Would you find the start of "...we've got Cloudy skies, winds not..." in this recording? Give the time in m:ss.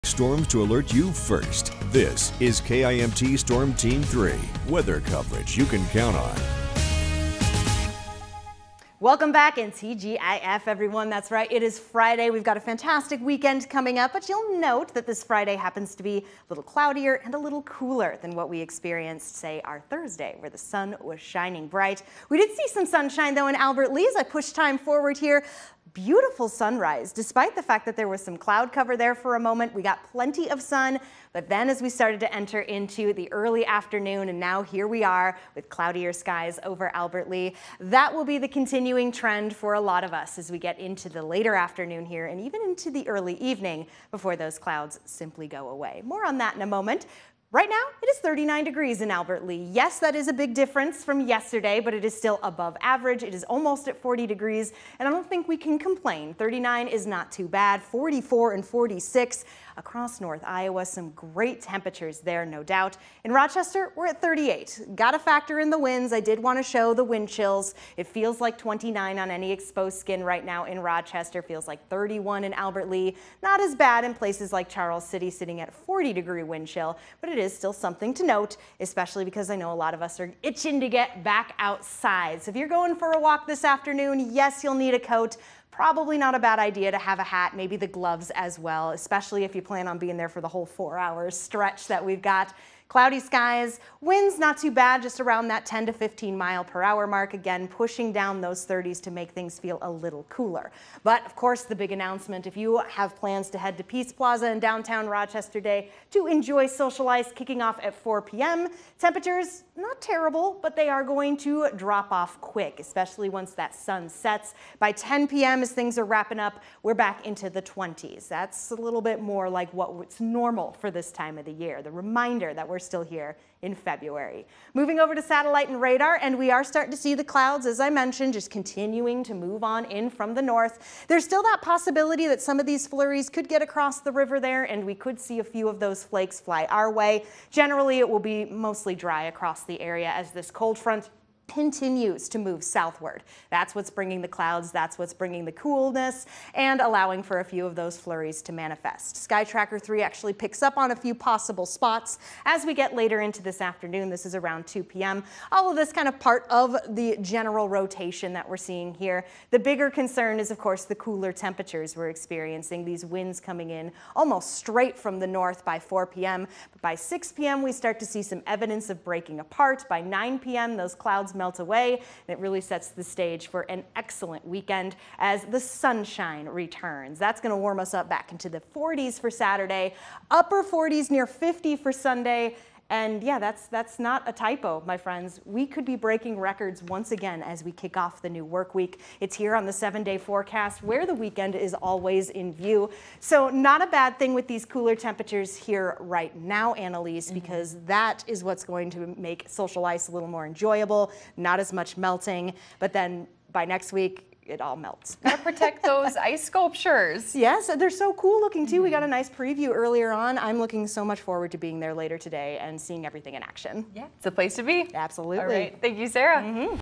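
1:32.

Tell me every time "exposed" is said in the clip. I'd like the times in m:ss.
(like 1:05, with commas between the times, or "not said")
1:09.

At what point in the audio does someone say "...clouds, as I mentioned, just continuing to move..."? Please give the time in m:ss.
2:07.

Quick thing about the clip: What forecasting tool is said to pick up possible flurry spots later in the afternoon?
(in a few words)
Sky Tracker 3.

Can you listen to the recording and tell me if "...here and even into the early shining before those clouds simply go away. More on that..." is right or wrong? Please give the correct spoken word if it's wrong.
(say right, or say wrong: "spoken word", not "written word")
wrong: "evening", not "shining".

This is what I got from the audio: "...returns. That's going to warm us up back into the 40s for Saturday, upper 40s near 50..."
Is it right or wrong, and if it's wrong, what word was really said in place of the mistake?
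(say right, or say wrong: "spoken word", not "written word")
right.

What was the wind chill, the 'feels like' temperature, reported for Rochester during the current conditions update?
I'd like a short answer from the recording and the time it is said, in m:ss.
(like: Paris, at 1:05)
29, at 1:08.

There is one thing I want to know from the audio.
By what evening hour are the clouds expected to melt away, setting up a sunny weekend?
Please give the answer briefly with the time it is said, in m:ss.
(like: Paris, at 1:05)
9 p.m., at 2:50.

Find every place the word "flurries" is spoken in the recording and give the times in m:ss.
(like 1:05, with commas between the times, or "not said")
2:12, 2:27.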